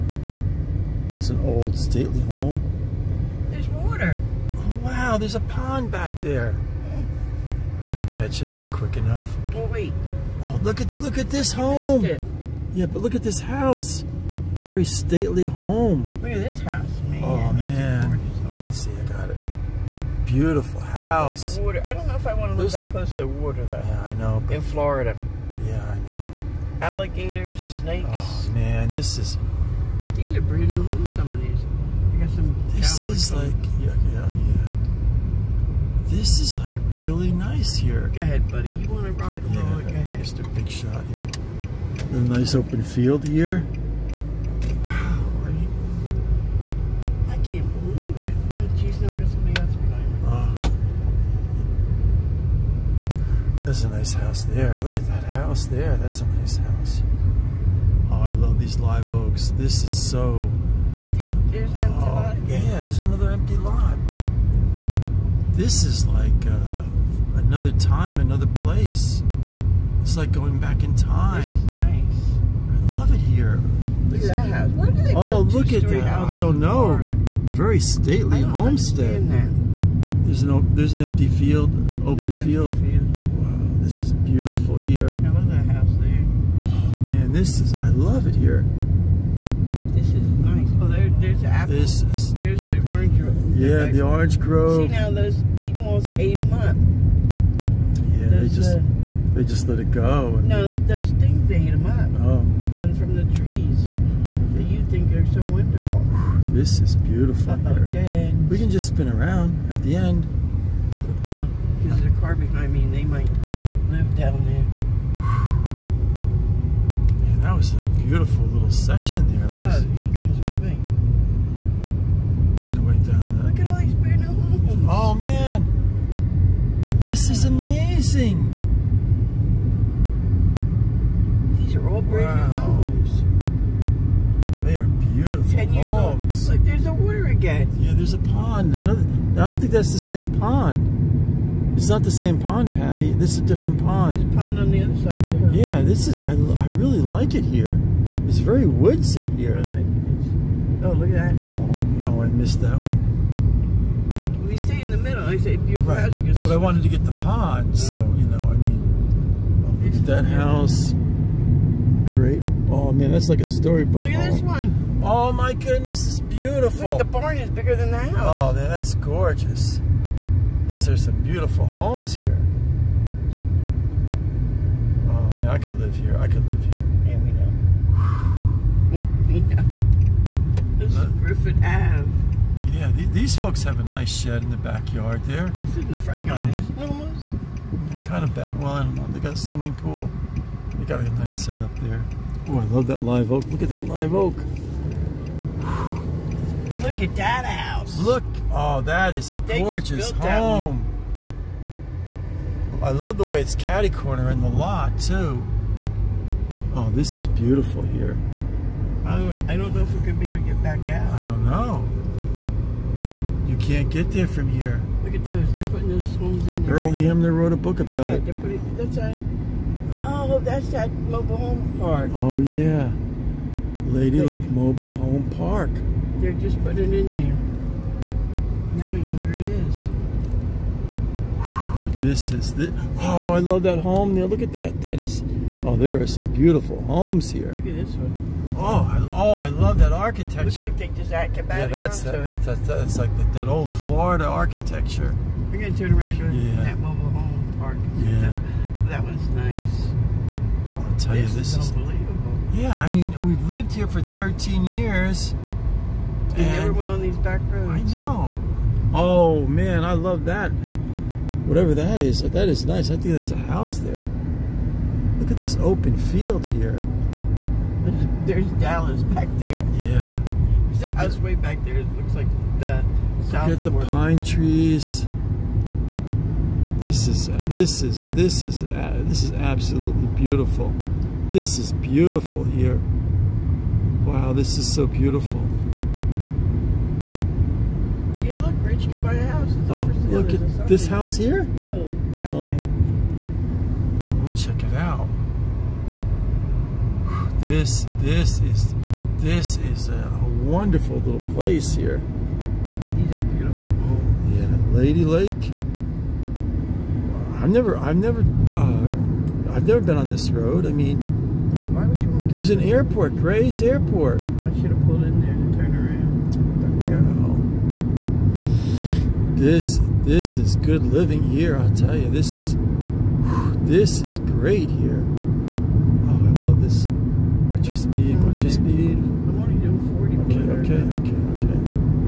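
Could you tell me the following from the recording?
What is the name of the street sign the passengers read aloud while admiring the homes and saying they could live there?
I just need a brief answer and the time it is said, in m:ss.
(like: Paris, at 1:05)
Griffin Ave, at 3:00.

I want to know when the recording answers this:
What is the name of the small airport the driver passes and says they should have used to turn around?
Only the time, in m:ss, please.
5:13.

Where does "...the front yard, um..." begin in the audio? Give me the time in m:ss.
3:05.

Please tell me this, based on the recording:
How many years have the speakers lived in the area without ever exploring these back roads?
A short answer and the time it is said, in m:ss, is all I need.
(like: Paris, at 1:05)
13, at 4:14.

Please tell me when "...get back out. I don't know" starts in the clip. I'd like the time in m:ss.
3:30.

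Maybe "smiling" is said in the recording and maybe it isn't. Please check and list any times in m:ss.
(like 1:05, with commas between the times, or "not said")
not said.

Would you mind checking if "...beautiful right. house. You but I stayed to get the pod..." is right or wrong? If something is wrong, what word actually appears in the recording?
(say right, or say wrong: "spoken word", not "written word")
wrong: "wanted", not "stayed".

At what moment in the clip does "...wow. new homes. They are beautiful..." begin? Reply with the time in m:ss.
2:12.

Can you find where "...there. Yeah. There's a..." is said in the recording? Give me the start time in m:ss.
4:29.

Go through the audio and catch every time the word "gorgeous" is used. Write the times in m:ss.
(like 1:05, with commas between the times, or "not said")
2:48, 3:19.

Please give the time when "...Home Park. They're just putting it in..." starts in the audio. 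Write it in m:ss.
3:44.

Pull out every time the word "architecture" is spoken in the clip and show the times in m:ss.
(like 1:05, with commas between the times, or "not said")
3:59, 4:04.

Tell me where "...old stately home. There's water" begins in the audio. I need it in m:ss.
0:01.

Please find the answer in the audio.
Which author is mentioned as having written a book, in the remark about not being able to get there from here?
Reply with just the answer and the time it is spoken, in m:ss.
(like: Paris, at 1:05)
Earl Hamner, at 3:36.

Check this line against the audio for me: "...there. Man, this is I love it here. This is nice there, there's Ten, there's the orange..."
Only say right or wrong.
wrong.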